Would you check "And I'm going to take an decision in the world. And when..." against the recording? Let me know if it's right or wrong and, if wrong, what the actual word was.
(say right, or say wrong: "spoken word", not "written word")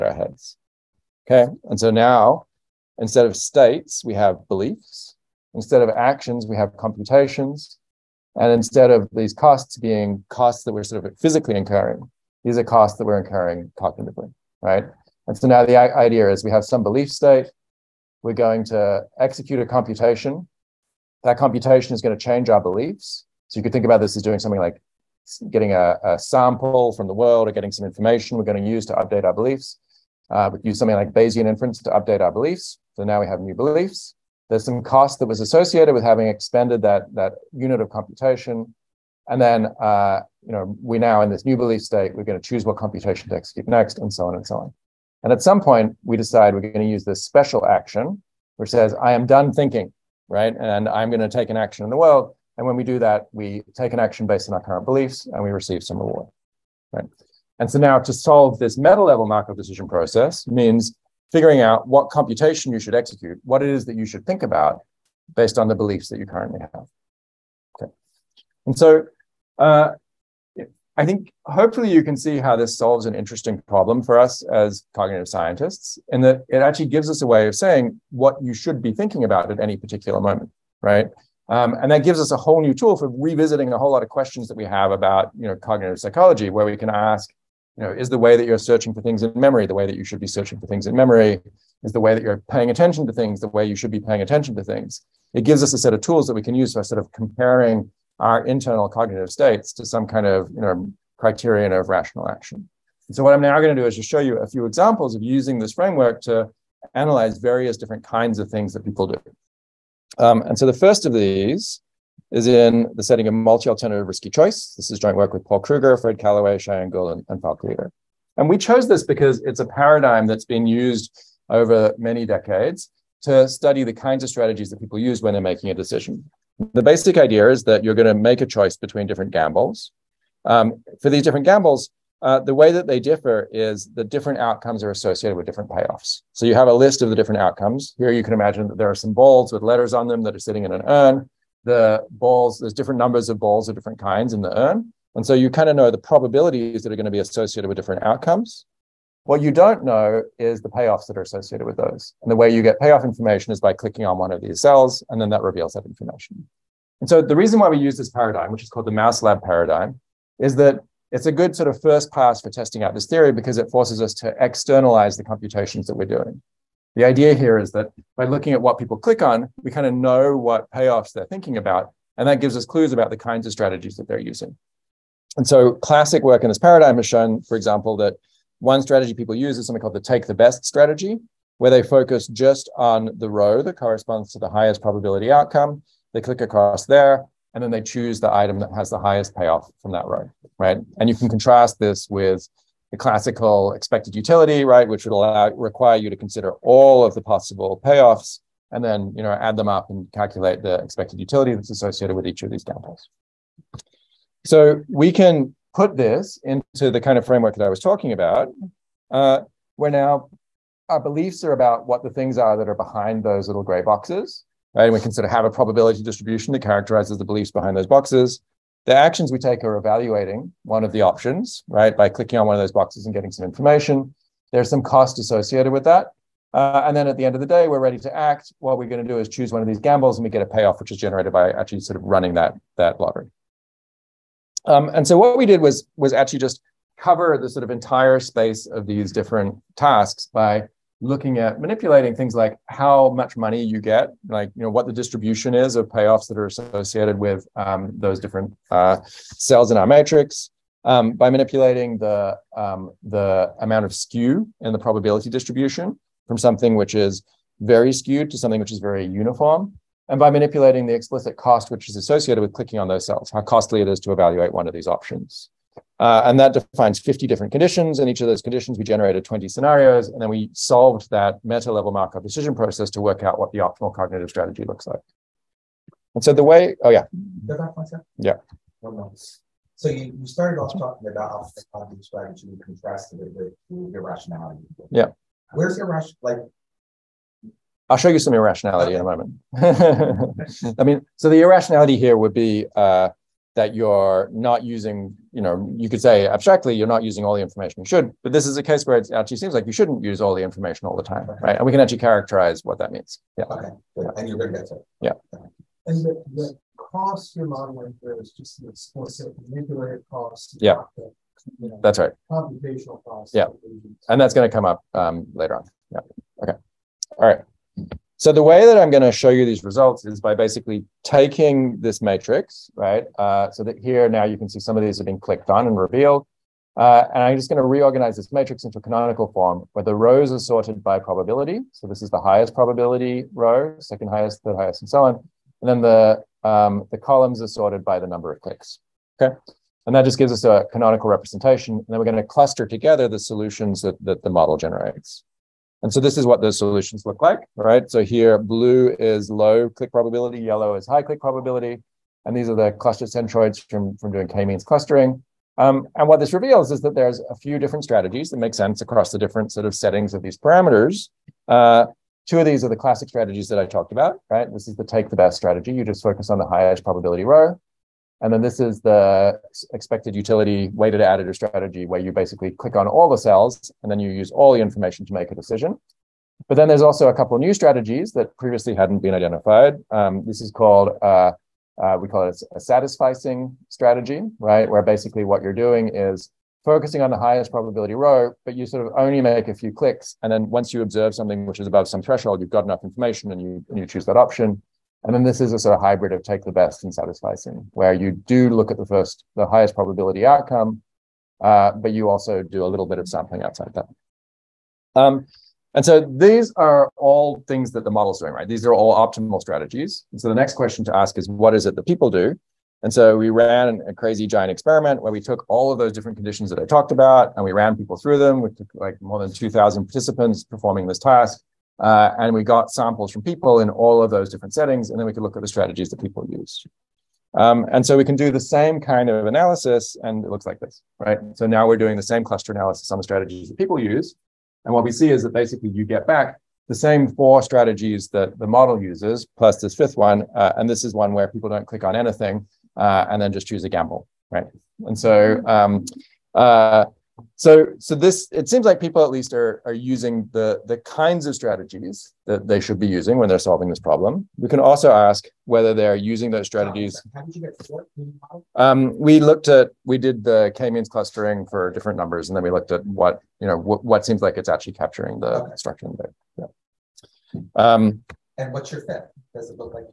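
wrong: "action", not "decision".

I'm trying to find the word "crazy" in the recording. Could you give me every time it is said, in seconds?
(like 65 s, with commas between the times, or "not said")
413 s.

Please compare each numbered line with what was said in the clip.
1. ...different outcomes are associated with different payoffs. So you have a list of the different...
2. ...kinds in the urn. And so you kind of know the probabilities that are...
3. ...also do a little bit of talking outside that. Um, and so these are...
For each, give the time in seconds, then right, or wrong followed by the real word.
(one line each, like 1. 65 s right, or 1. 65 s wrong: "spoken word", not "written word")
1. 134 s right
2. 143 s right
3. 402 s wrong: "sampling", not "talking".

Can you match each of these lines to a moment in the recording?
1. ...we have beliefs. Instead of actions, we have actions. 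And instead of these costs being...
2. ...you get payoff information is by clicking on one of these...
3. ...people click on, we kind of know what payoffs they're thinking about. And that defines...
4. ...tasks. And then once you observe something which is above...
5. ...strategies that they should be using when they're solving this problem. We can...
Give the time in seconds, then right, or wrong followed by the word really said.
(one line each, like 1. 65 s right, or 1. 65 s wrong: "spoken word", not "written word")
1. 4 s wrong: "computations", not "actions"
2. 152 s right
3. 168 s wrong: "gives", not "defines"
4. 389 s wrong: "clicks", not "tasks"
5. 451 s right.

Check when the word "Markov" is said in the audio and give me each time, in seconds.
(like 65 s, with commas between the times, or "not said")
59 s, 271 s.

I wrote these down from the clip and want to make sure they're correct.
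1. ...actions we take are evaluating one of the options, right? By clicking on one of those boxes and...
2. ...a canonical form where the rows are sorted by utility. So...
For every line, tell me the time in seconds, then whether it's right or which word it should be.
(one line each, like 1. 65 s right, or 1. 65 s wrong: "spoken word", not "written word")
1. 218 s right
2. 328 s wrong: "probability", not "utility".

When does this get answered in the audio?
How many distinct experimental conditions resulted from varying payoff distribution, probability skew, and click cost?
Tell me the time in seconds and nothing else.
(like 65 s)
266 s.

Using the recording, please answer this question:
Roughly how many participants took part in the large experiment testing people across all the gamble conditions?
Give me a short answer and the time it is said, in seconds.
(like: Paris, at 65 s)
more than 2,000, at 418 s.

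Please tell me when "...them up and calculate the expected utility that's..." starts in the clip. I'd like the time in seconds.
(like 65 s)
199 s.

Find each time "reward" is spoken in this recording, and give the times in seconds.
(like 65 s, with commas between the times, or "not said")
55 s.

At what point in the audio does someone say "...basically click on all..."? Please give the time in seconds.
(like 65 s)
372 s.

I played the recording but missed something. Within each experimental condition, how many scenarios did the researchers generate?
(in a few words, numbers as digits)
20.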